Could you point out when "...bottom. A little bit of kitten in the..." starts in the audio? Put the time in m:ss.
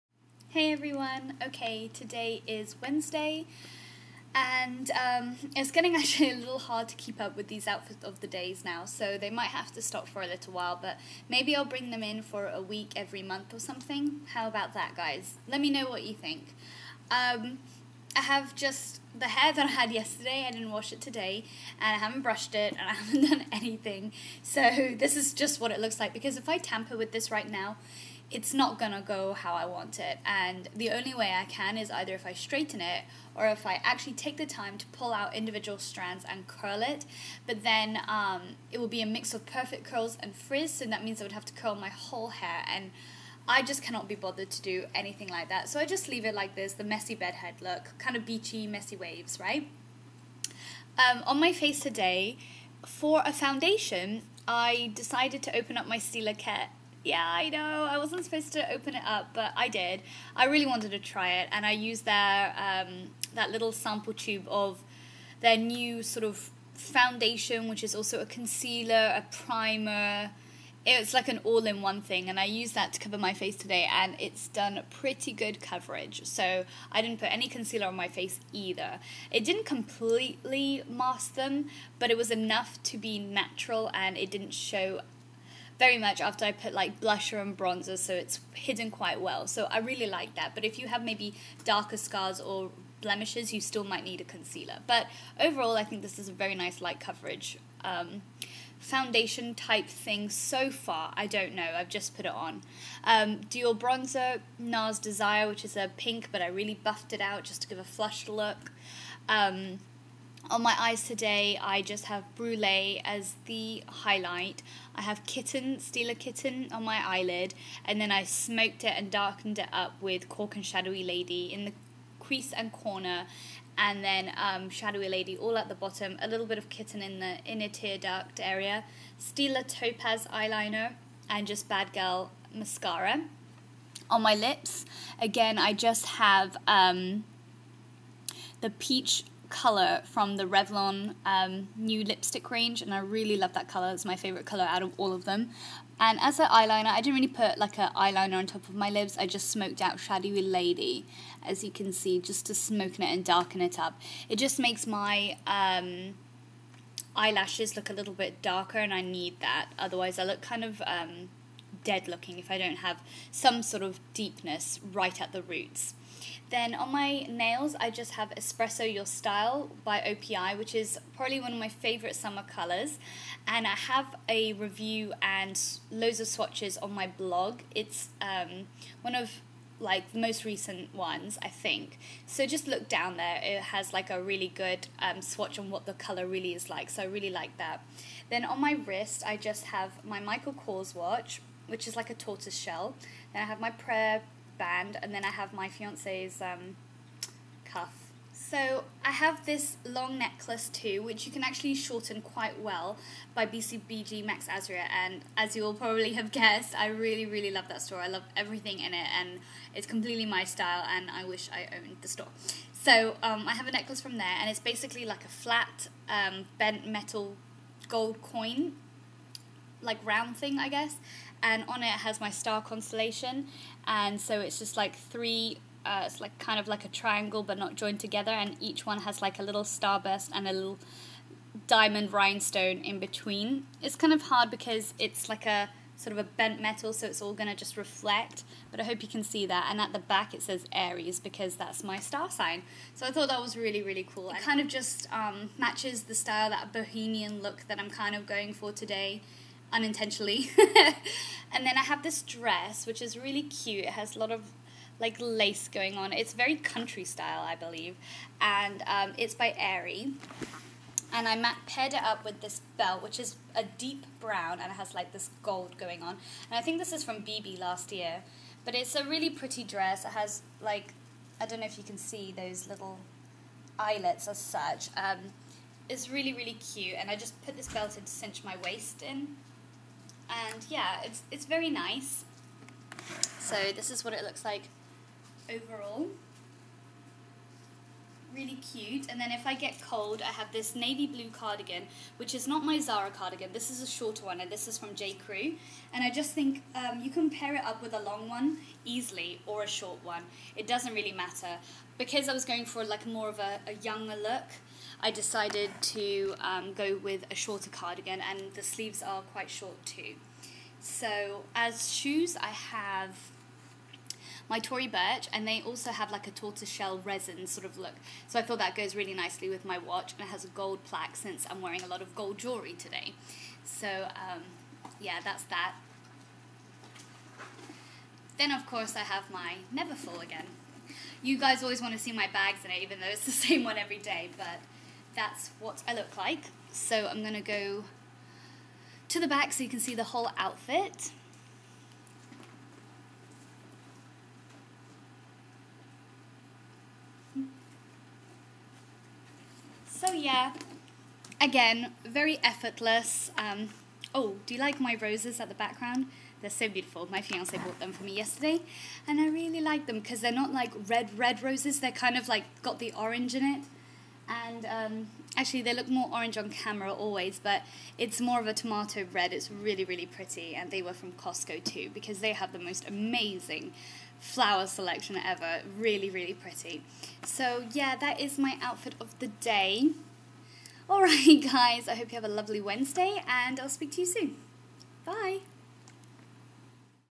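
2:05.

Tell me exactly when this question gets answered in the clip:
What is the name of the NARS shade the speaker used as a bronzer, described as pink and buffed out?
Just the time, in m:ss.
1:45.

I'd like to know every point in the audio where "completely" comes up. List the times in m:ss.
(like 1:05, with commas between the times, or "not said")
1:19, 3:29.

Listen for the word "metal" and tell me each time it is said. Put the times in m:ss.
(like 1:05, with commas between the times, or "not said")
3:36, 3:56.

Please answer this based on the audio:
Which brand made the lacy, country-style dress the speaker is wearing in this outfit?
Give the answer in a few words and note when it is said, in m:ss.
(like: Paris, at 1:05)
Aerie, at 4:19.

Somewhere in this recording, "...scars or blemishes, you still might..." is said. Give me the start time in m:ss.
1:31.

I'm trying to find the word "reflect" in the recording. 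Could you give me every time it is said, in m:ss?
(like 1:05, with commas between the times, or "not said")
3:57.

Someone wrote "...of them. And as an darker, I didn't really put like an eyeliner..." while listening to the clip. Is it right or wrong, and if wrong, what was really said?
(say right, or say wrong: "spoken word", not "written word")
wrong: "eyeliner", not "darker".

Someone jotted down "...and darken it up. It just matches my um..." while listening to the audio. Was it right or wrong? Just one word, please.
wrong.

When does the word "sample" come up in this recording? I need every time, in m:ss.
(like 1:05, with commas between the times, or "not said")
1:03.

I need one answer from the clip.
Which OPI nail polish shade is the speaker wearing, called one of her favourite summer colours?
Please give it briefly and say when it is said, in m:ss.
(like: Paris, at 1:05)
Espresso Your Style, at 2:48.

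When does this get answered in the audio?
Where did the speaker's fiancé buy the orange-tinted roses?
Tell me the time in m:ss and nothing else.
6:11.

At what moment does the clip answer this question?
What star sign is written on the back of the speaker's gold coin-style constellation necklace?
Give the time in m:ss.
4:00.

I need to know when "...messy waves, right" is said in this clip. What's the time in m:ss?
0:48.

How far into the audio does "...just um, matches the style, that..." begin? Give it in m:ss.
4:04.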